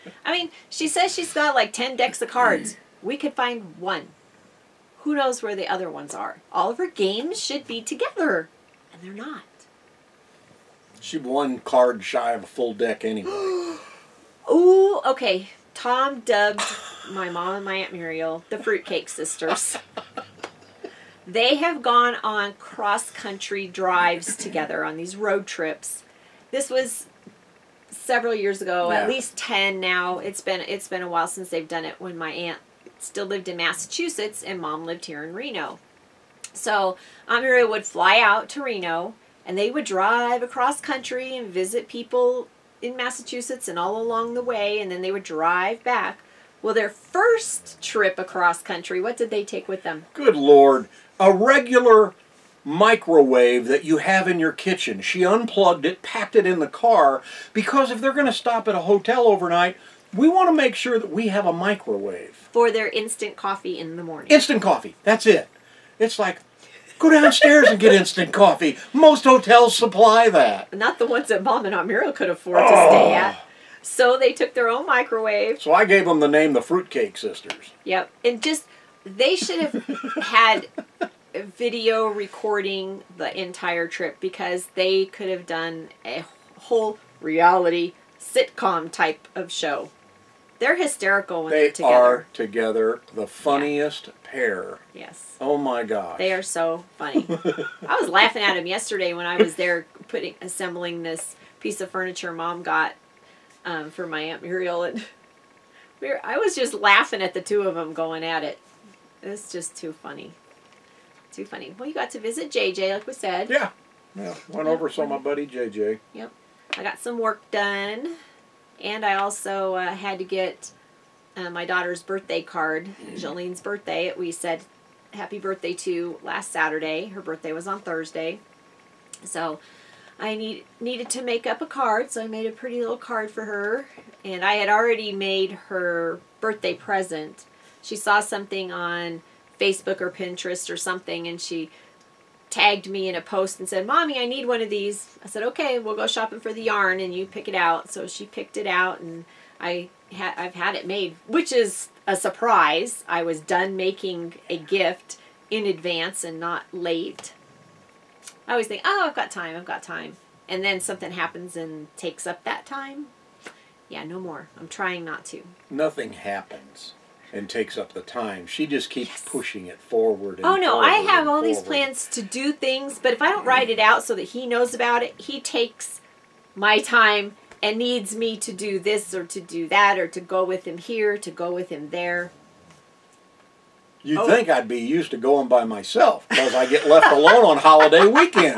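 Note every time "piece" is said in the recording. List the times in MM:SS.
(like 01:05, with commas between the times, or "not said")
01:41.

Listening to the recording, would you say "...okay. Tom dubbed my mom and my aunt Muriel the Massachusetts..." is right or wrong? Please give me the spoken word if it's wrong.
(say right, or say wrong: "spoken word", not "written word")
wrong: "Fruitcake", not "Massachusetts".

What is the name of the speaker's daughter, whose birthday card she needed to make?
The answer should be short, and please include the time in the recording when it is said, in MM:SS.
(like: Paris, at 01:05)
Jolene, at 02:03.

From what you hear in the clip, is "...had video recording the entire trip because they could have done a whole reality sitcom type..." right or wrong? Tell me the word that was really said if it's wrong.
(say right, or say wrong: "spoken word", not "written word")
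right.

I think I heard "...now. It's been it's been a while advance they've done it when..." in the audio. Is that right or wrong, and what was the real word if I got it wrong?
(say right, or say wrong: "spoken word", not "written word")
wrong: "since", not "advance".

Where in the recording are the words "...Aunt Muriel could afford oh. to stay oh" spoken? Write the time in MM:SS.
01:11.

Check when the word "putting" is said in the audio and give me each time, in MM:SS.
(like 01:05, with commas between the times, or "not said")
01:40.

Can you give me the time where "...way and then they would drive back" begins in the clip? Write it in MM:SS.
00:44.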